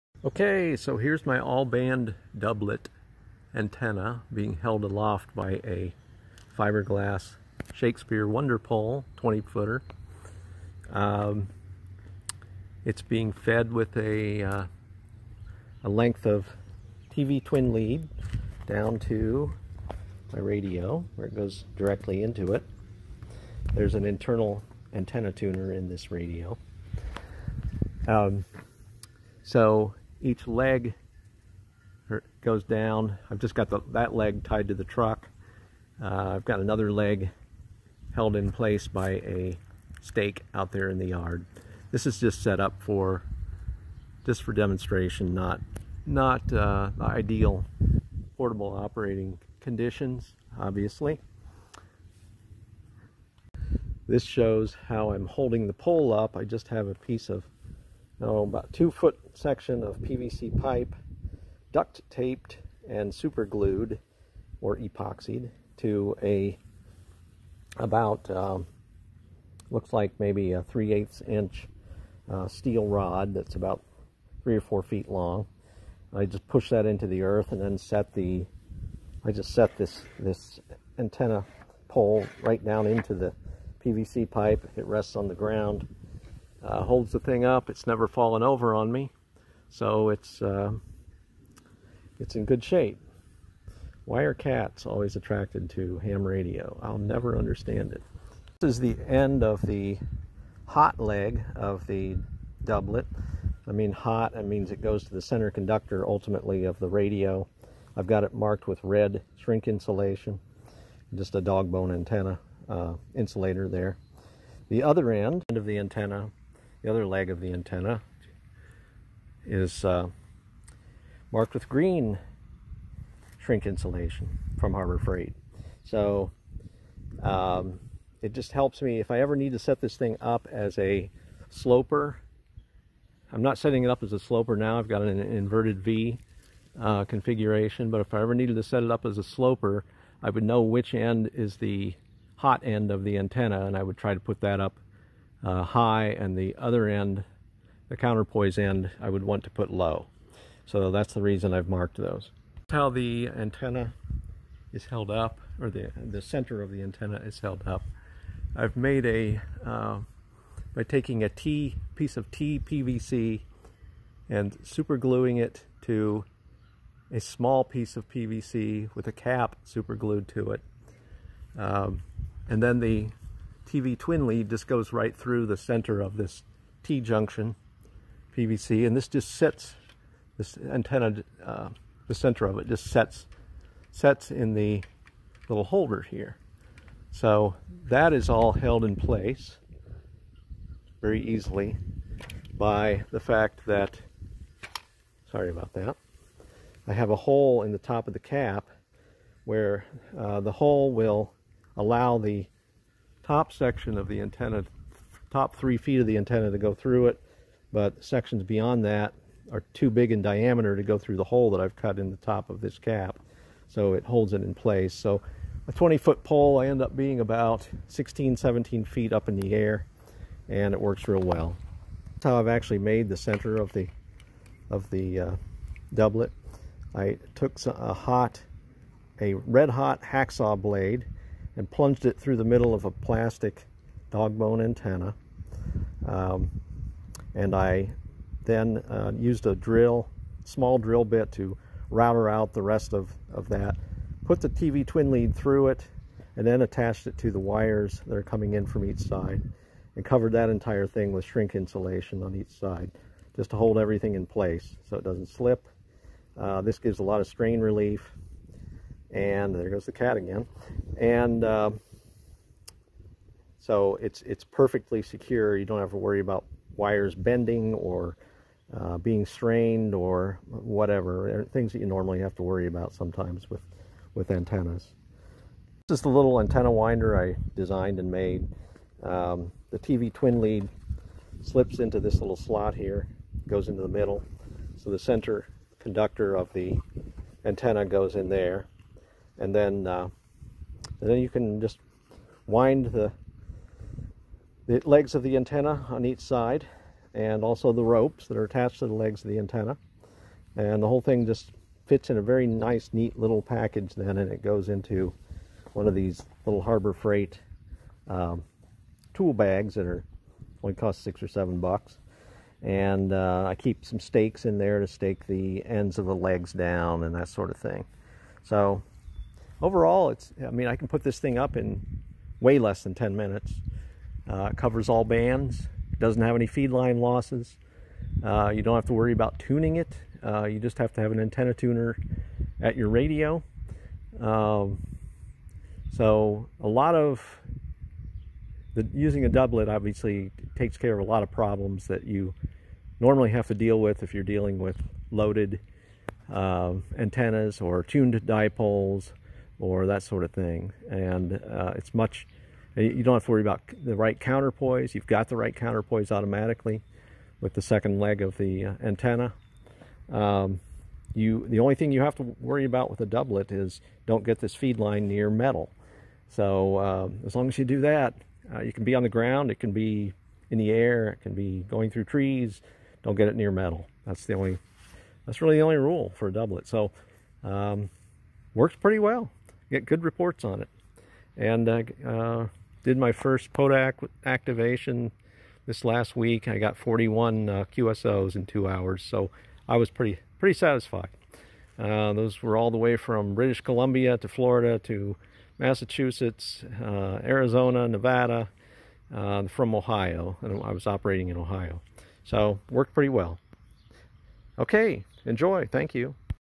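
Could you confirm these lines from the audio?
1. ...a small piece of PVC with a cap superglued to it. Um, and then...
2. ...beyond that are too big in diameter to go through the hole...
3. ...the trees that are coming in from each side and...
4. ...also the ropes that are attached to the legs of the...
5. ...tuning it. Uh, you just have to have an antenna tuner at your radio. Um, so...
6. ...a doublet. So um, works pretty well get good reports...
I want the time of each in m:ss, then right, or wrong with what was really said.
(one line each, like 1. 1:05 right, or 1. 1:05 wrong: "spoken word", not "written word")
1. 2:47 right
2. 3:28 right
3. 4:07 wrong: "wires", not "trees"
4. 4:57 right
5. 5:29 right
6. 6:16 right.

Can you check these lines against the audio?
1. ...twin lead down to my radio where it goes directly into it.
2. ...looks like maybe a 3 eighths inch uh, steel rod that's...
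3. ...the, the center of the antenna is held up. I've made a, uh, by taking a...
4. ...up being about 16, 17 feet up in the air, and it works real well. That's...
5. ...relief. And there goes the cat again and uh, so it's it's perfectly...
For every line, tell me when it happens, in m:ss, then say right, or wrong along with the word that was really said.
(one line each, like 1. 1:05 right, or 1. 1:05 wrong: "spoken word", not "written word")
1. 0:17 right
2. 1:09 right
3. 2:35 right
4. 3:36 right
5. 4:17 right.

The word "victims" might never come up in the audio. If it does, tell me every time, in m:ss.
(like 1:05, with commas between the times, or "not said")
not said.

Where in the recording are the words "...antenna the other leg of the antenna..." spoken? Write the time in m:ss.
1:55.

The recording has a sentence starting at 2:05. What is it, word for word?
So um, it just helps me if I ever need to set this thing up as a sloper.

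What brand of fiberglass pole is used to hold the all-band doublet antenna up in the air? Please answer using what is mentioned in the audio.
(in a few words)
Shakespeare Wonderpole.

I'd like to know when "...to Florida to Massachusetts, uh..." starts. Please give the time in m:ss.
6:34.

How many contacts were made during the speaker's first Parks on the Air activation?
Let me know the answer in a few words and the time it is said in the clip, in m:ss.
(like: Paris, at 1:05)
41, at 6:26.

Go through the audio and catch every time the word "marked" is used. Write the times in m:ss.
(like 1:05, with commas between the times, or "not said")
1:48, 2:01, 2:31.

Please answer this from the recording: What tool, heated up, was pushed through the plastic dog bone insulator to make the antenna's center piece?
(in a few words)
hacksaw blade.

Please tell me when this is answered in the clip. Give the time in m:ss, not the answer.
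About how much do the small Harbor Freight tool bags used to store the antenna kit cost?
5:11.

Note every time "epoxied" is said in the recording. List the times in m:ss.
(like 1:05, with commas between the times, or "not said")
1:04.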